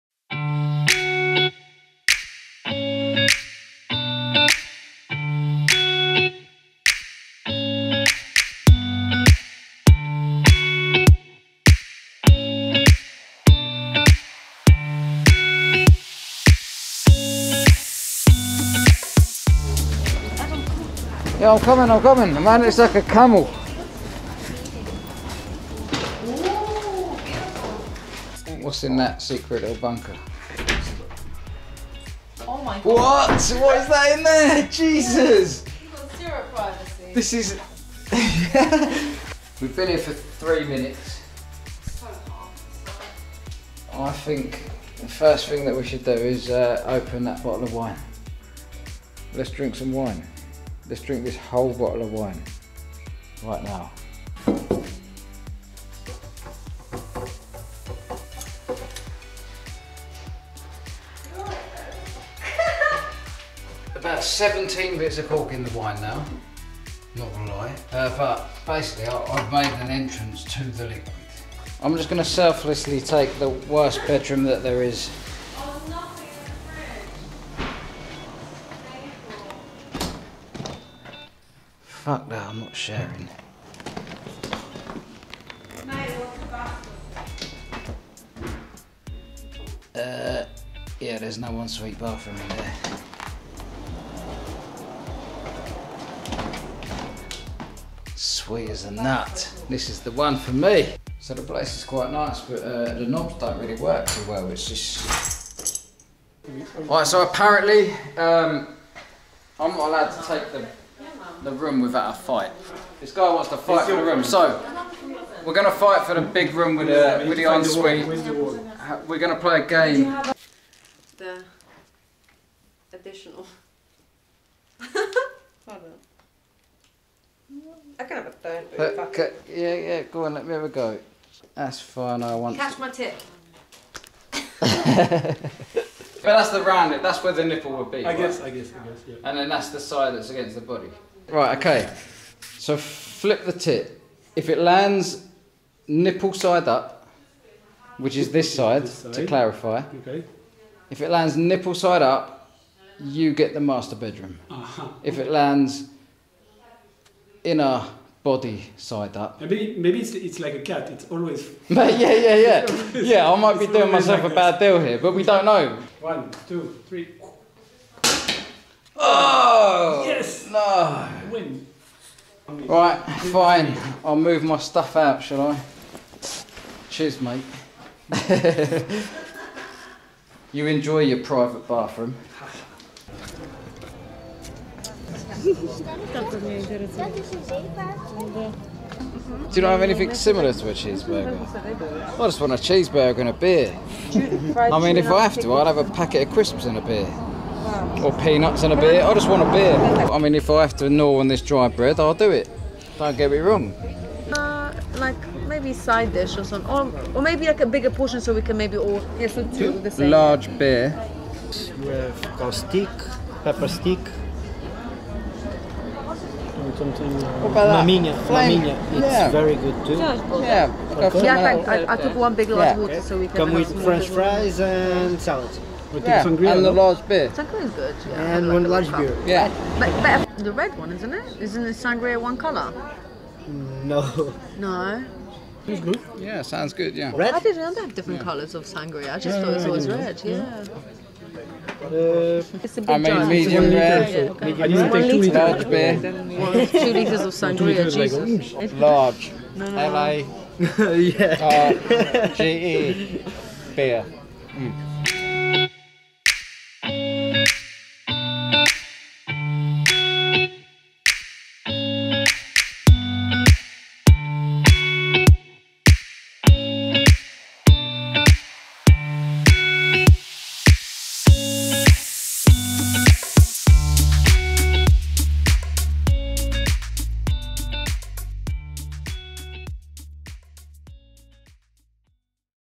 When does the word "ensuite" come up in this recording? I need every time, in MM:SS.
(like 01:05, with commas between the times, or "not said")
01:57.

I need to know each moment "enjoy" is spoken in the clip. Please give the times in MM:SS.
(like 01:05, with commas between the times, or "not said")
03:00.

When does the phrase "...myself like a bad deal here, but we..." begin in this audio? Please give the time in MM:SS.
02:43.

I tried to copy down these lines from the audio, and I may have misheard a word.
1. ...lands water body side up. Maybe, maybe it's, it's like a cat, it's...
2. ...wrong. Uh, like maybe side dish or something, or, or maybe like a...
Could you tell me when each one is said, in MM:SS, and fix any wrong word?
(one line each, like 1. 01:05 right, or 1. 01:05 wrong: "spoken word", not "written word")
1. 02:35 wrong: "inner", not "water"
2. 03:23 right.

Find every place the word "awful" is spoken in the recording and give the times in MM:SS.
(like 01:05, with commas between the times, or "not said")
not said.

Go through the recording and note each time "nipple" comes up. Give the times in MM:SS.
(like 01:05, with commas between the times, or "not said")
02:17, 02:25, 02:31.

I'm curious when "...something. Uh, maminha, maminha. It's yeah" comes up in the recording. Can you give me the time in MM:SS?
03:36.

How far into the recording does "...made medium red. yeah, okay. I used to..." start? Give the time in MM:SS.
04:02.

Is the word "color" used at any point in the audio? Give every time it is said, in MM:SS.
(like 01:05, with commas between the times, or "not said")
03:52, 03:58.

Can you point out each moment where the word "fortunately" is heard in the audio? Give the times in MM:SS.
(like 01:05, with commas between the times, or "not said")
not said.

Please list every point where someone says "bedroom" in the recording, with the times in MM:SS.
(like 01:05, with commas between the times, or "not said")
01:14, 02:33.